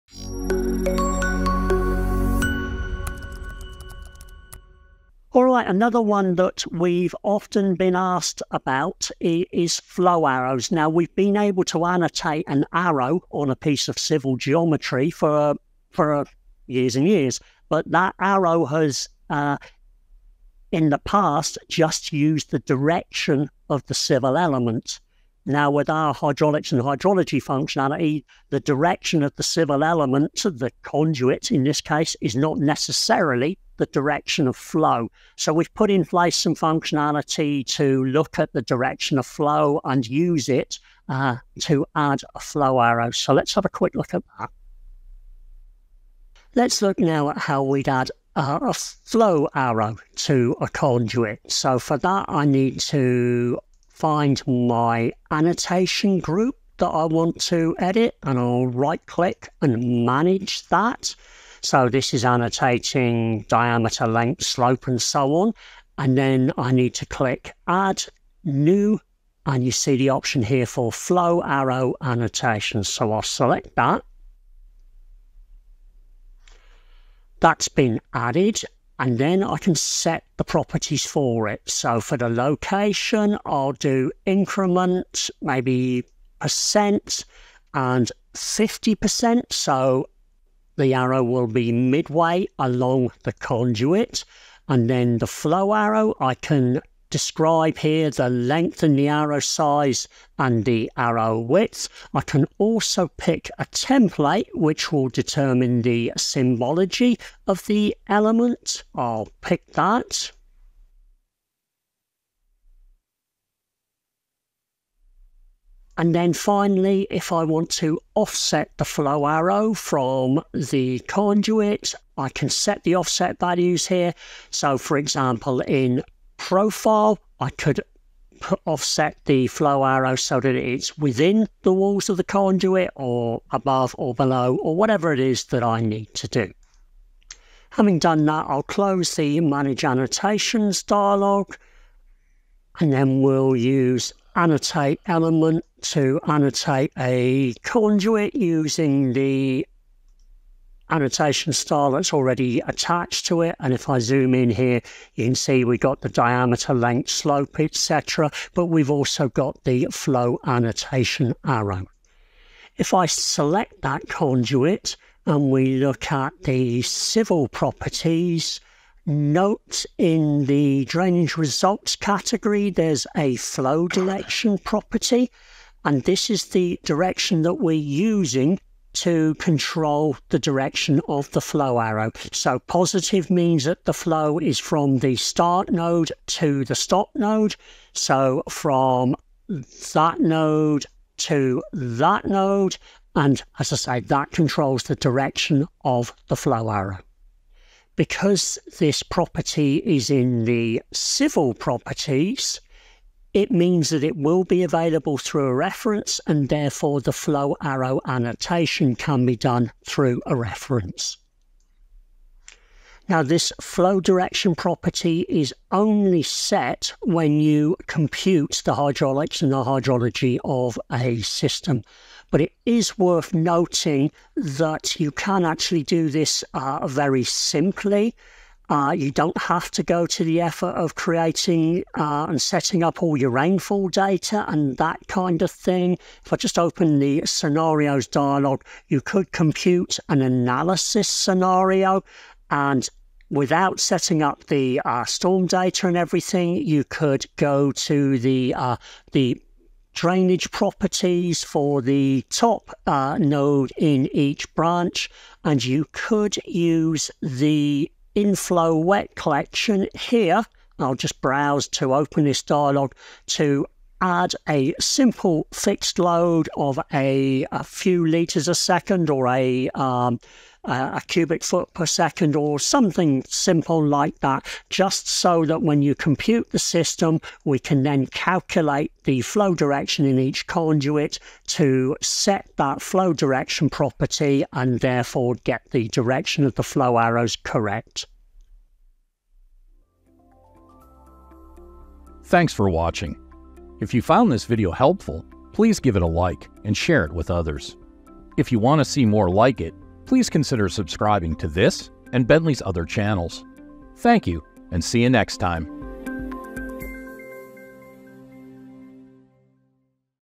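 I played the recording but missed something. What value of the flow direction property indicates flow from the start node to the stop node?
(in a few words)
positive.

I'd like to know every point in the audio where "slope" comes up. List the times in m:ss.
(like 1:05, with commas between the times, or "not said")
1:04, 2:37.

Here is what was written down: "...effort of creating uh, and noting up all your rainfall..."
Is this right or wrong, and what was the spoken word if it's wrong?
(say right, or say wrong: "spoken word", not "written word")
wrong: "setting", not "noting".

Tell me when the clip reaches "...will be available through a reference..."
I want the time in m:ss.
3:24.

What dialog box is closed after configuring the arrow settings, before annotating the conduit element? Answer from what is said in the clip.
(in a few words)
Manage Annotations.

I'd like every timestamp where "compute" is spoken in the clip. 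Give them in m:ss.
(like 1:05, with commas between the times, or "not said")
3:37, 3:59, 4:35.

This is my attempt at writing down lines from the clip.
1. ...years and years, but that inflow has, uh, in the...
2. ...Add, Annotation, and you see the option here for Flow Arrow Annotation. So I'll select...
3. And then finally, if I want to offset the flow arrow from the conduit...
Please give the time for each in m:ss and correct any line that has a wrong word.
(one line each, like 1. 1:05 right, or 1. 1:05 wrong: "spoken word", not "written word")
1. 0:16 wrong: "arrow", not "inflow"
2. 1:07 wrong: "New", not "Annotation"
3. 1:55 right.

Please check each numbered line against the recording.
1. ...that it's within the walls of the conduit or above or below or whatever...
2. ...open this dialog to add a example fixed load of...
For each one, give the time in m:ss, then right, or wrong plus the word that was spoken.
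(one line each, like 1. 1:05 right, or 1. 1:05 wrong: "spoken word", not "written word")
1. 2:10 right
2. 4:21 wrong: "simple", not "example".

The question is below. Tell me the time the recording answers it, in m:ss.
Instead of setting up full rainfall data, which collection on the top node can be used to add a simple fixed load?
4:18.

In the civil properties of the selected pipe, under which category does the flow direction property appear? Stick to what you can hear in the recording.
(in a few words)
drainage results.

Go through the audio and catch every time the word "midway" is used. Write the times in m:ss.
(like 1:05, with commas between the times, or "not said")
1:31.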